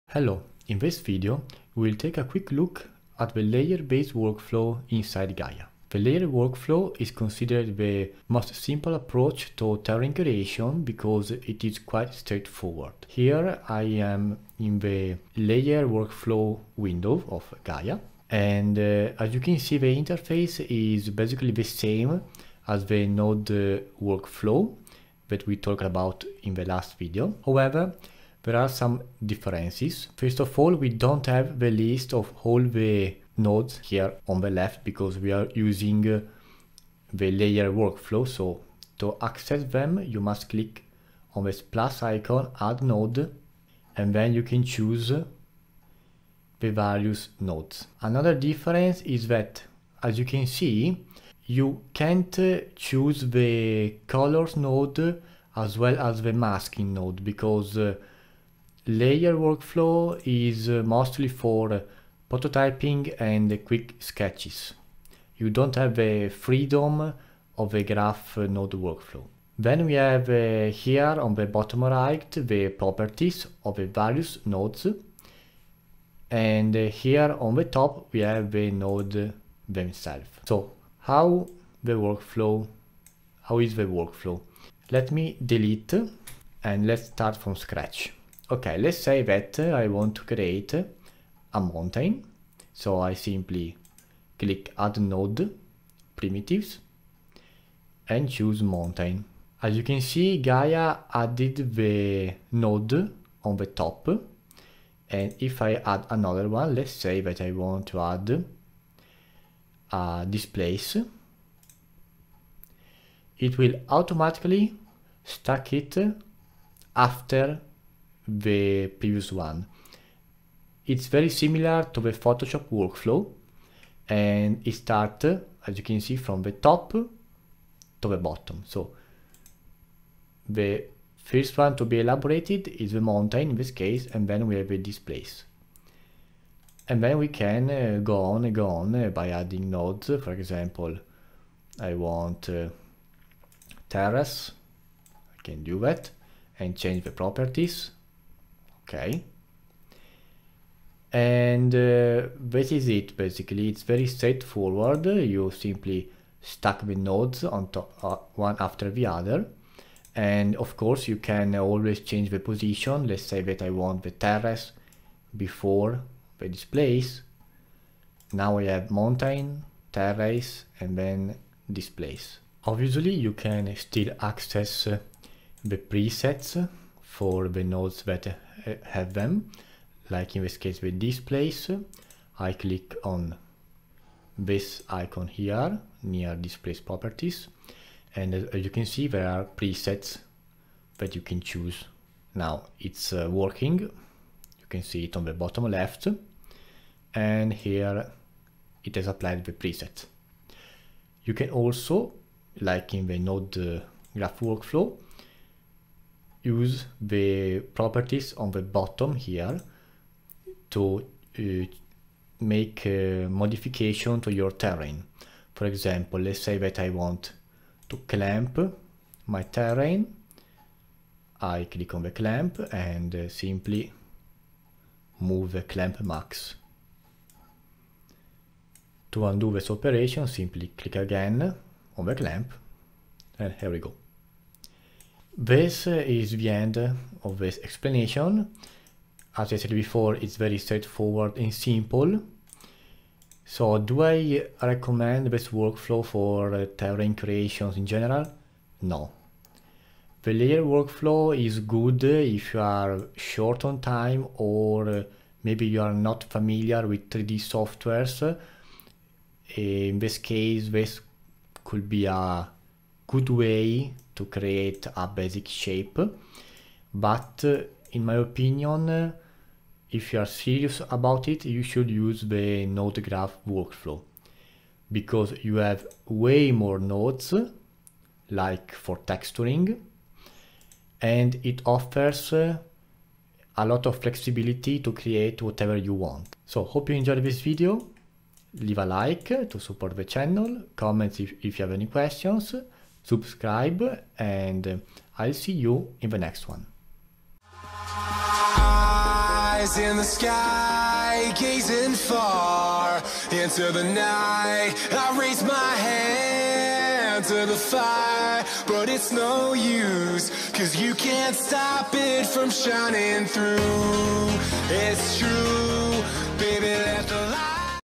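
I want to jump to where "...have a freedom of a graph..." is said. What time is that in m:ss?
1:05.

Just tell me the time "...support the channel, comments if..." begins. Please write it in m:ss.
4:49.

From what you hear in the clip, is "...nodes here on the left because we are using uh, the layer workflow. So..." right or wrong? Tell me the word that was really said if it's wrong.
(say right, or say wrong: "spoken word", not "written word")
right.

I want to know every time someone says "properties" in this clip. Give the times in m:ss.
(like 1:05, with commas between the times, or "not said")
1:12, 2:27, 3:06, 3:27.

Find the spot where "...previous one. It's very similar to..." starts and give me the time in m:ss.
1:58.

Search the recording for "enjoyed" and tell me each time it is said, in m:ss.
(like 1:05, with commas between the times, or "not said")
4:46.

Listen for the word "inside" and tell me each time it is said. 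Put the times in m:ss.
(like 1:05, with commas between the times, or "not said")
0:04.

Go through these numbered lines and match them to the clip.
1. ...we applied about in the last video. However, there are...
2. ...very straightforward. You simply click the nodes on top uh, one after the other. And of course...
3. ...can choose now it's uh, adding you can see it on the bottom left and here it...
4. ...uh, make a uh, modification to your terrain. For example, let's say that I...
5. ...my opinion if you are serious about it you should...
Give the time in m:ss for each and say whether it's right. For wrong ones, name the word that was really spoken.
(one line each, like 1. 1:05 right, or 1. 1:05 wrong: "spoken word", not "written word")
1. 0:25 wrong: "talked", not "applied"
2. 2:33 wrong: "stack", not "click"
3. 3:11 wrong: "working", not "adding"
4. 3:31 right
5. 4:28 right.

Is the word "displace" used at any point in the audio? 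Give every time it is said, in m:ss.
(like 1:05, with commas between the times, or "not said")
1:50, 2:14, 2:46, 2:51, 3:00, 3:06.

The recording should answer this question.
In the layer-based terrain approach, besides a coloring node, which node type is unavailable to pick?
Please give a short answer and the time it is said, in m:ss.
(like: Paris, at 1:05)
masking node, at 0:56.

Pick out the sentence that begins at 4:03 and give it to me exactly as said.
So do I recommend this workflow for uh, terrain creations in general?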